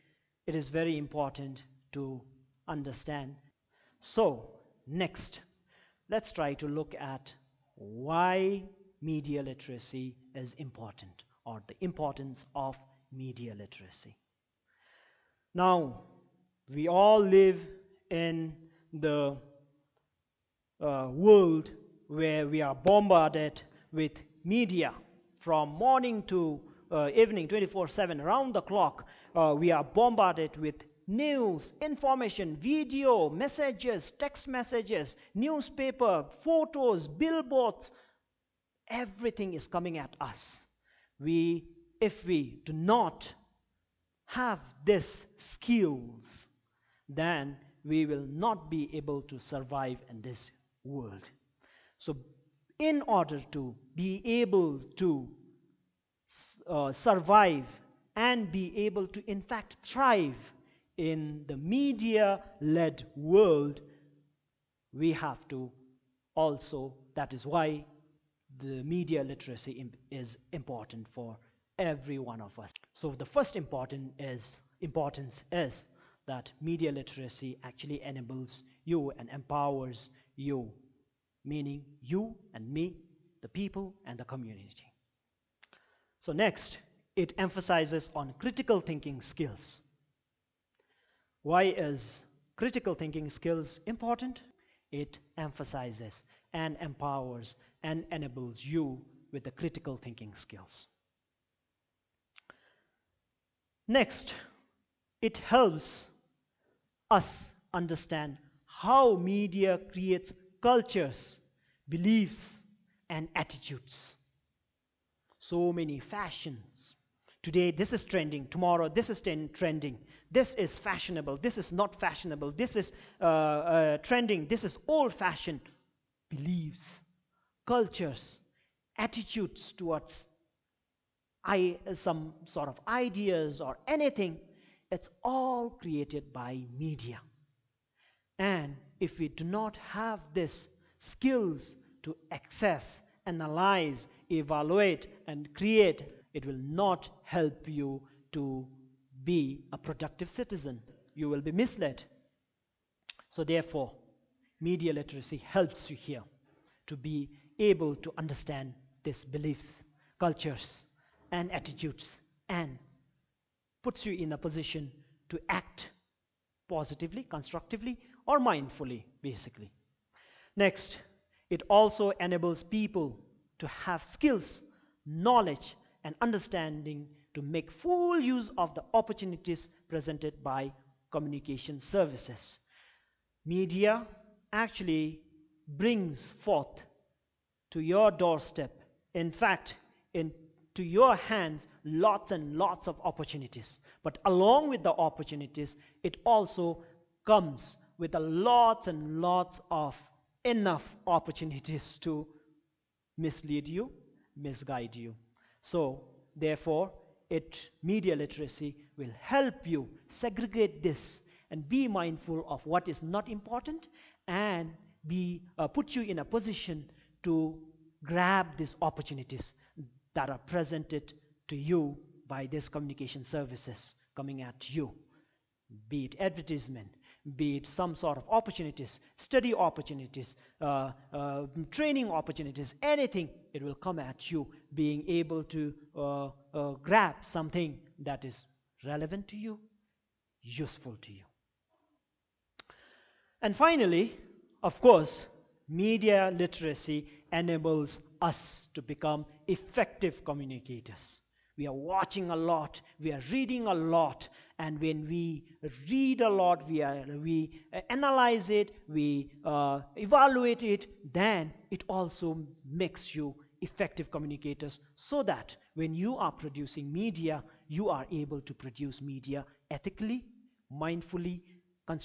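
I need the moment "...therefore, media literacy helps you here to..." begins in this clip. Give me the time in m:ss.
2:33.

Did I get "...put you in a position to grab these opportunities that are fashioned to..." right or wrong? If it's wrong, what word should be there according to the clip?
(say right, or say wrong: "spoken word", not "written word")
wrong: "presented", not "fashioned".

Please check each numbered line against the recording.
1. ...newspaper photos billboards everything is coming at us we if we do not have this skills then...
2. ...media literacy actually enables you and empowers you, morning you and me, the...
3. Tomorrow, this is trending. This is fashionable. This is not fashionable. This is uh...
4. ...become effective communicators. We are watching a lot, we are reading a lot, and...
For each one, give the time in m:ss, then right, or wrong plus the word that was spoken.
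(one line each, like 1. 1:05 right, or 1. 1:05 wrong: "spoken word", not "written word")
1. 0:35 right
2. 1:16 wrong: "meaning", not "morning"
3. 1:58 right
4. 4:08 right.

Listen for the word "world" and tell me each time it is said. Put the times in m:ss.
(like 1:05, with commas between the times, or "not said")
0:21, 0:50, 1:03.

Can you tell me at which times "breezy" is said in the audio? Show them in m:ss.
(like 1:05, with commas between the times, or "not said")
not said.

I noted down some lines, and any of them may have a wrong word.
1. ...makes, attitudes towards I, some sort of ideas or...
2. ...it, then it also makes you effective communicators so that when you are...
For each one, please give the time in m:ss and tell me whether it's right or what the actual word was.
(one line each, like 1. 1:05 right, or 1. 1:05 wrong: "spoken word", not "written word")
1. 2:07 wrong: "cultures", not "makes"
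2. 4:20 right.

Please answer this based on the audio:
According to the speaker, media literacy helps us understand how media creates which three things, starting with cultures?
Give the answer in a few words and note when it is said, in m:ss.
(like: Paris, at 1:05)
beliefs and attitudes, at 1:50.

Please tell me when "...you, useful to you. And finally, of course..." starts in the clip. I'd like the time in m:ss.
3:59.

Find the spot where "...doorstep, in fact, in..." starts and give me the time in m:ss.
3:08.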